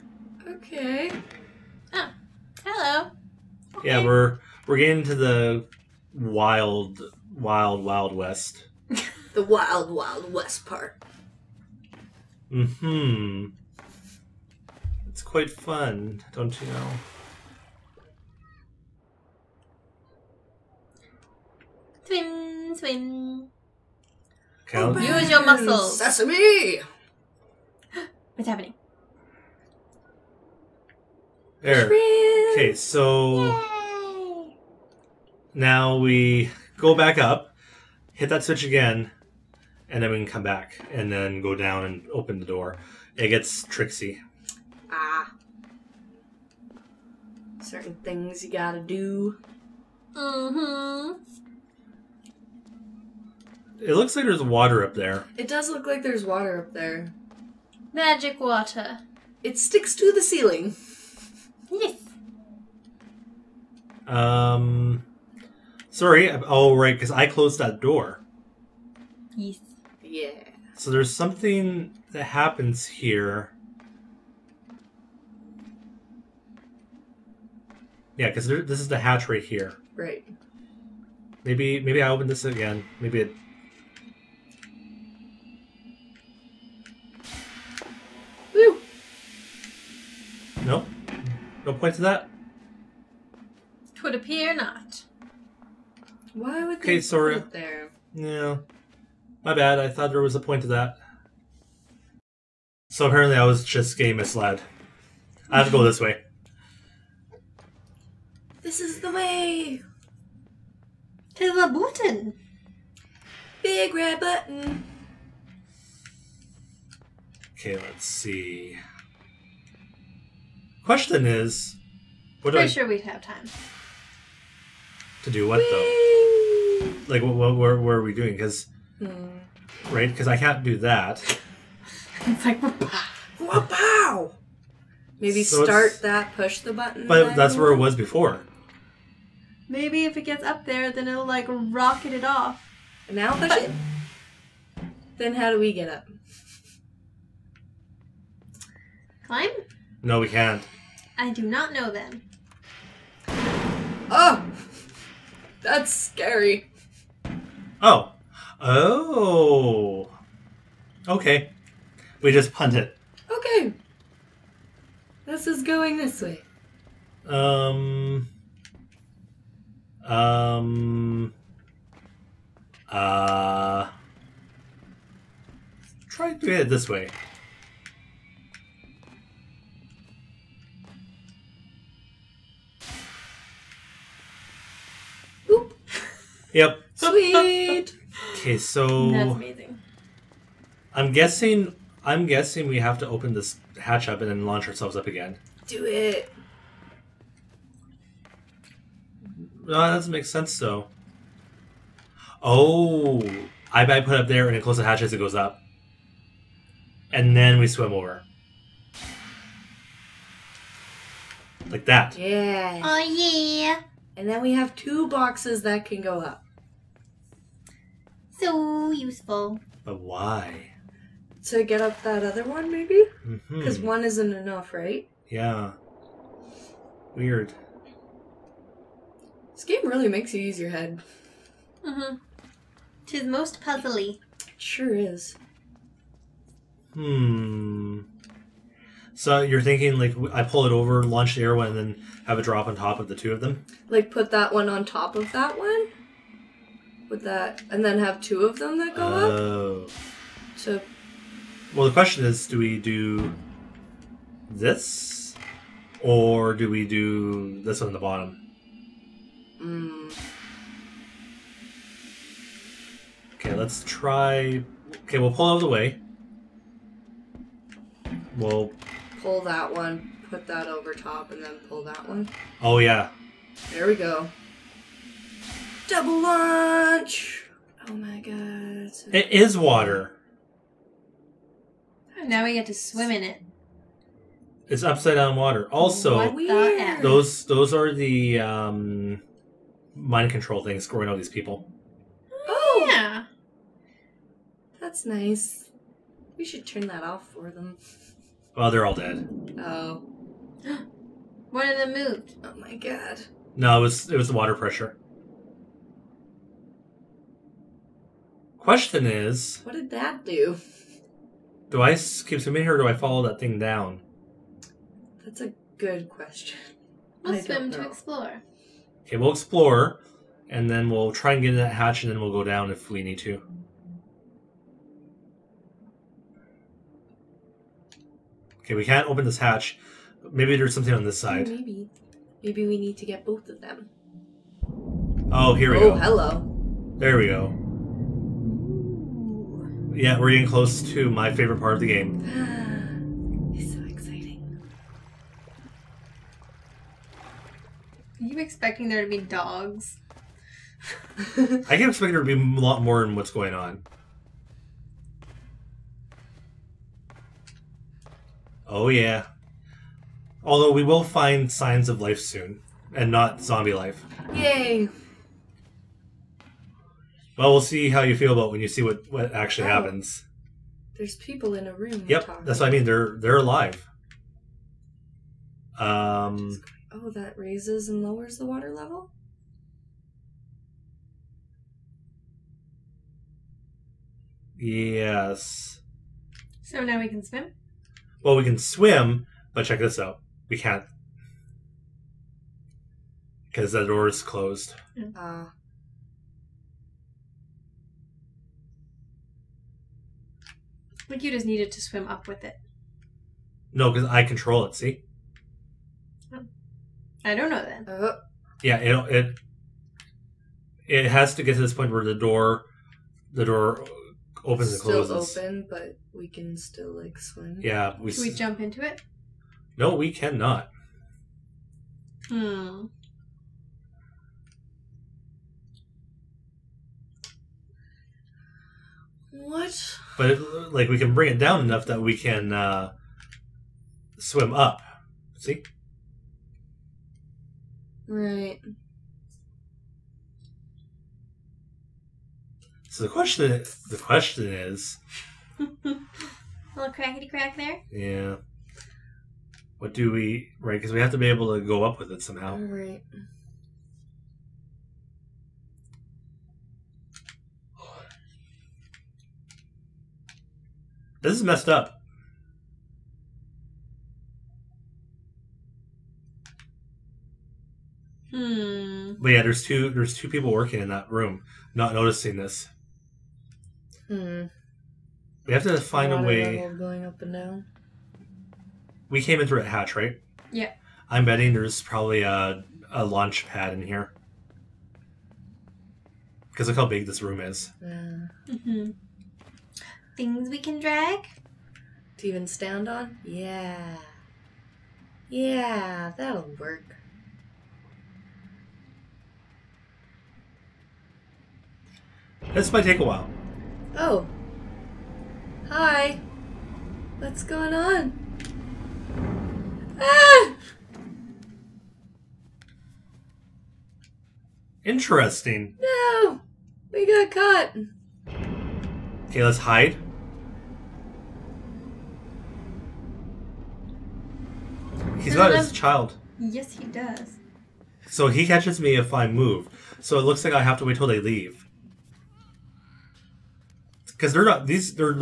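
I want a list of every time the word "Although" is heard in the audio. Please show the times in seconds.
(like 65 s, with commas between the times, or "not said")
360 s.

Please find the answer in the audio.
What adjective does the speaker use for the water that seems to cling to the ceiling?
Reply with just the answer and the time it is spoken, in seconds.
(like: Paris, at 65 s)
magic, at 57 s.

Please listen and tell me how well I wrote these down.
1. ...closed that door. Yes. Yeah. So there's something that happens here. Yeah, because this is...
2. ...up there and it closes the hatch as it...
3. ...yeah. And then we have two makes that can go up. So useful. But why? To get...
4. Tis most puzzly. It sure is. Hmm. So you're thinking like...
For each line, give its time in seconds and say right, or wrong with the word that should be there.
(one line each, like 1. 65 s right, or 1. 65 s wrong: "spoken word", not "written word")
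1. 67 s right
2. 204 s right
3. 212 s wrong: "boxes", not "makes"
4. 233 s right.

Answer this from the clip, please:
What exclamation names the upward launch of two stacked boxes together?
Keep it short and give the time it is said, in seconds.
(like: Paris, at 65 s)
Double lunch, at 275 s.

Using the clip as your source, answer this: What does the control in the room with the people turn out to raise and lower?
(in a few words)
water level.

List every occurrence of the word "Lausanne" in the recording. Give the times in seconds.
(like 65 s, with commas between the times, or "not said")
not said.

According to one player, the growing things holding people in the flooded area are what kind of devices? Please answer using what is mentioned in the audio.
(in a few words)
mind control things.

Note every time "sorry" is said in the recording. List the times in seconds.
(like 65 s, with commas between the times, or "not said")
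65 s, 97 s.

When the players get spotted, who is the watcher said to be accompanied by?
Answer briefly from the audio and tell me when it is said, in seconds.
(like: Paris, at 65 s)
his child, at 525 s.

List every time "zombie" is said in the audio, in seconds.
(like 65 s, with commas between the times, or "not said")
363 s.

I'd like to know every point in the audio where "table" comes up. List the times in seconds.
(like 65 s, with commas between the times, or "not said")
not said.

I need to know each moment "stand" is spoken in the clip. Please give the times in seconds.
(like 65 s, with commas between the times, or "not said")
492 s.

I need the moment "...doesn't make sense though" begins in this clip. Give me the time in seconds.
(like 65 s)
199 s.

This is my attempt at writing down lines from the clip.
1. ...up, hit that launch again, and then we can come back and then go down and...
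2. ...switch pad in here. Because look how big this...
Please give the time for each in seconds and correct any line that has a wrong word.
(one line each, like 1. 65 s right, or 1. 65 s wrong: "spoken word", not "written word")
1. 37 s wrong: "switch", not "launch"
2. 483 s wrong: "launch", not "switch".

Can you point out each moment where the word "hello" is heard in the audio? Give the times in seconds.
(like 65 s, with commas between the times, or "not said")
2 s, 335 s.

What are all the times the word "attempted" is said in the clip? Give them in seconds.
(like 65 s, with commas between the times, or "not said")
not said.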